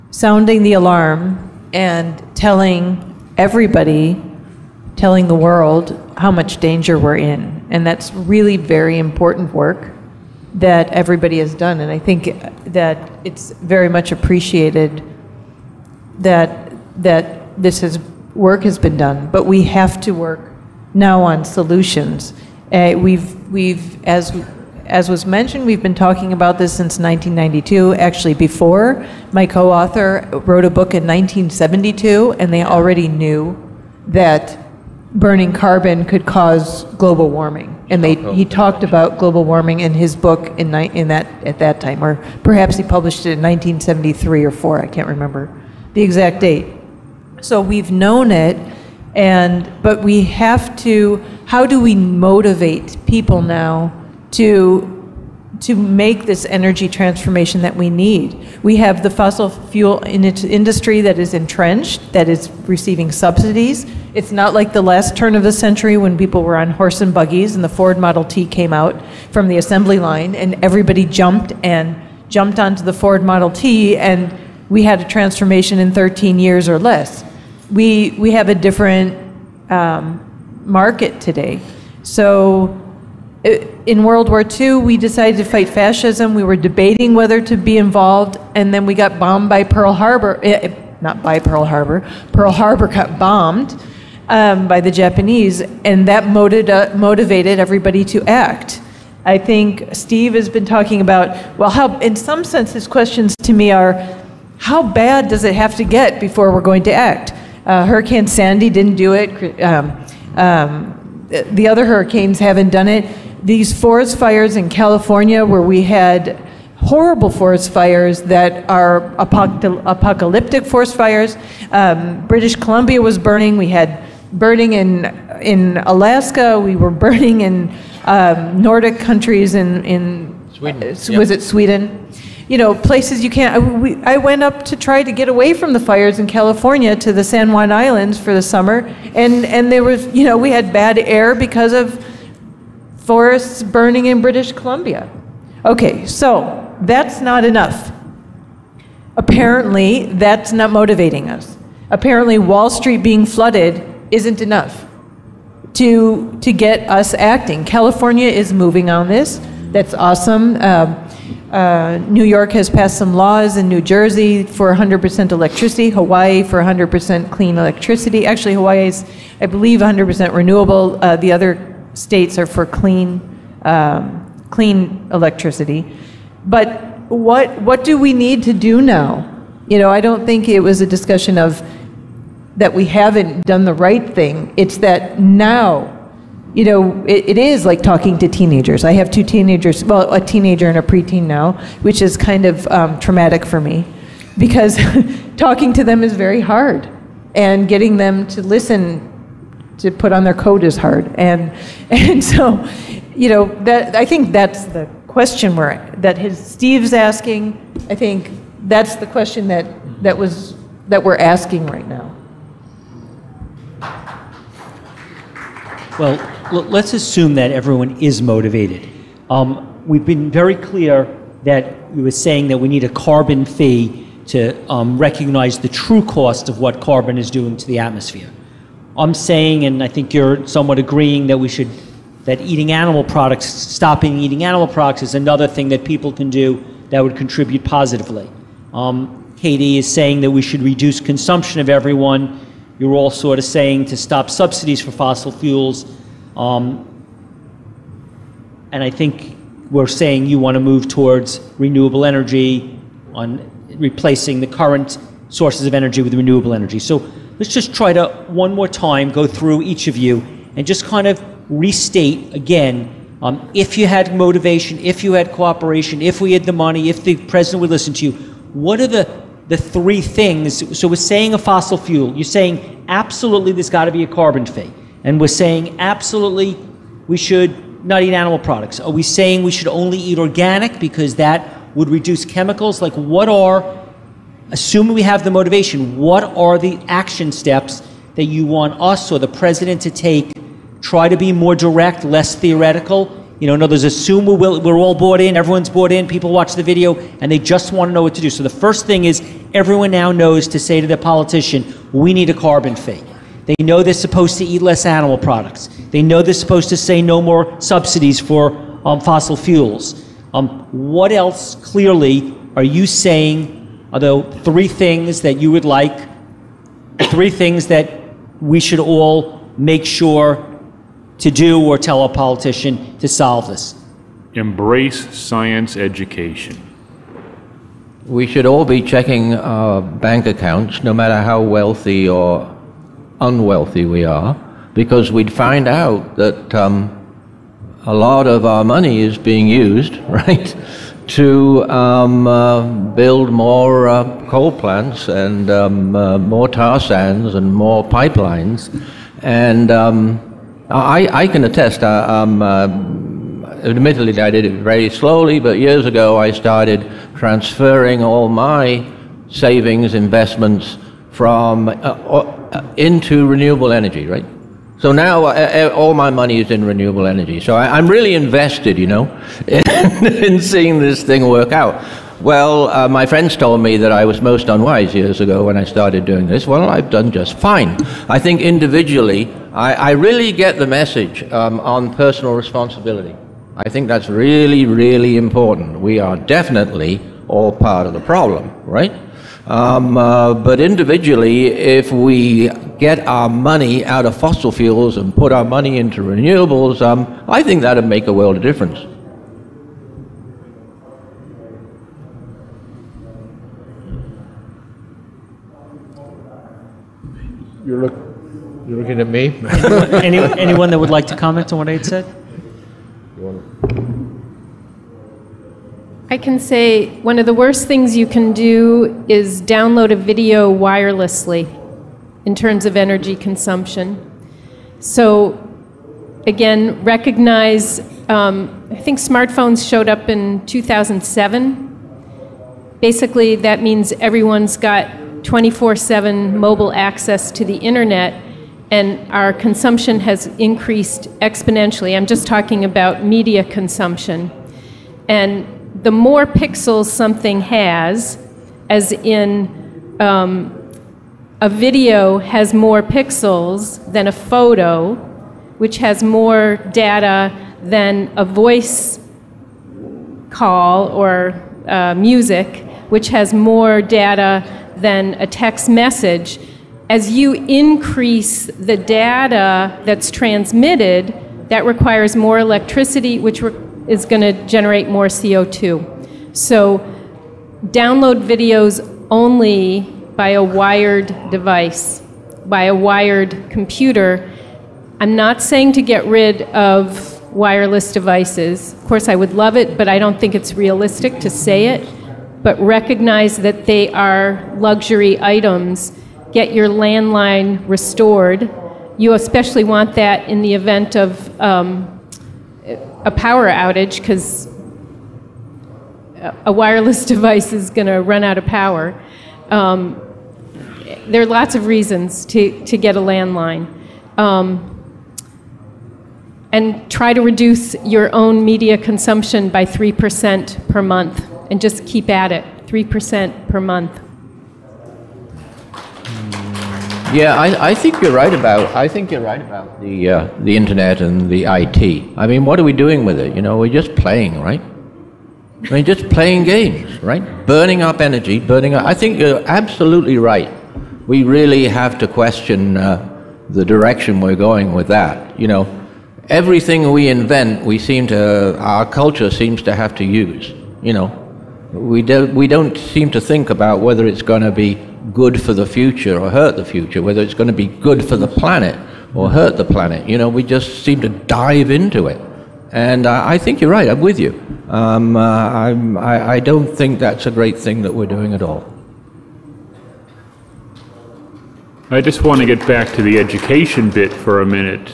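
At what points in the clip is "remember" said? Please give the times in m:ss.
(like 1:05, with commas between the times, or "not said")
0:45.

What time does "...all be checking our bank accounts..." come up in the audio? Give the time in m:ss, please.
5:28.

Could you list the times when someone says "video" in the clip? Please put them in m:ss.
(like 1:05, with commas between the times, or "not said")
4:56, 6:59, 7:31, 7:58.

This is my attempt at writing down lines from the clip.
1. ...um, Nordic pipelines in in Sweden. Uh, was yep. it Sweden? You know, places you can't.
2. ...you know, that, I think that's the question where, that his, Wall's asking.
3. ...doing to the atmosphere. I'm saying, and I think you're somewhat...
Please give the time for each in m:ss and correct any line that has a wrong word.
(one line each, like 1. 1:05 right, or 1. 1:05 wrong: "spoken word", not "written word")
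1. 2:08 wrong: "countries", not "pipelines"
2. 3:23 wrong: "Steve", not "Wall"
3. 3:47 right.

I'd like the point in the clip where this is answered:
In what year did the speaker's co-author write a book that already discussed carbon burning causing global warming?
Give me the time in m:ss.
0:31.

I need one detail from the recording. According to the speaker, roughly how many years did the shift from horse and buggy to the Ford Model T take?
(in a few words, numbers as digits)
13 years.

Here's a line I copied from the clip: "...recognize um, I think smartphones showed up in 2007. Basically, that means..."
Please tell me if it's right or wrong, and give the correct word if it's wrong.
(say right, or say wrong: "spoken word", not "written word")
right.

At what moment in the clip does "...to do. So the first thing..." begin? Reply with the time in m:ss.
4:58.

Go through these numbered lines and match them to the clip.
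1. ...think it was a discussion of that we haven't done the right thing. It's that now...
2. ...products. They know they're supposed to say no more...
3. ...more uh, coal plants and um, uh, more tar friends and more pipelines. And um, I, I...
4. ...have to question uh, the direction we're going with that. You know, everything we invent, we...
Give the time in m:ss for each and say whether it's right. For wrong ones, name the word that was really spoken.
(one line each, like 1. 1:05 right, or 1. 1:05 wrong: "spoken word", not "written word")
1. 3:00 right
2. 5:05 right
3. 5:43 wrong: "sands", not "friends"
4. 9:01 right.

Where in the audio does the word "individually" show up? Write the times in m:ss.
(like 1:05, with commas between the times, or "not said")
6:18, 6:30.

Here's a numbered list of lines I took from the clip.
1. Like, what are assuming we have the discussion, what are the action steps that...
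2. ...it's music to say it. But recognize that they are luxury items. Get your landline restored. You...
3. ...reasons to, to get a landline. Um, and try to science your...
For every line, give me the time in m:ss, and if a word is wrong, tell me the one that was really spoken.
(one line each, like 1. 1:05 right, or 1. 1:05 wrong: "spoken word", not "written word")
1. 4:42 wrong: "motivation", not "discussion"
2. 8:10 wrong: "realistic", not "music"
3. 8:31 wrong: "reduce", not "science".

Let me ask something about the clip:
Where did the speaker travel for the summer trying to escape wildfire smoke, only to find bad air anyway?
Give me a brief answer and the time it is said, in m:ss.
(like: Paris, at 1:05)
San Juan Islands, at 2:17.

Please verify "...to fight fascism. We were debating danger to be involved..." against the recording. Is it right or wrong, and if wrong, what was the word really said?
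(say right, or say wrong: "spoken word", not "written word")
wrong: "whether", not "danger".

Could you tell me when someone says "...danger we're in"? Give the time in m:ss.
0:06.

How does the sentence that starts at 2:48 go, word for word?
Actually, Hawaii is, I believe, 100% renewable.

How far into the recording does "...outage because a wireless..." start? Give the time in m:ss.
8:23.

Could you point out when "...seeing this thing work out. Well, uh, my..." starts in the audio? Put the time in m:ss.
6:10.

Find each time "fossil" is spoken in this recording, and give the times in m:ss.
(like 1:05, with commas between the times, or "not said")
0:59, 4:04, 4:31, 5:09, 6:34.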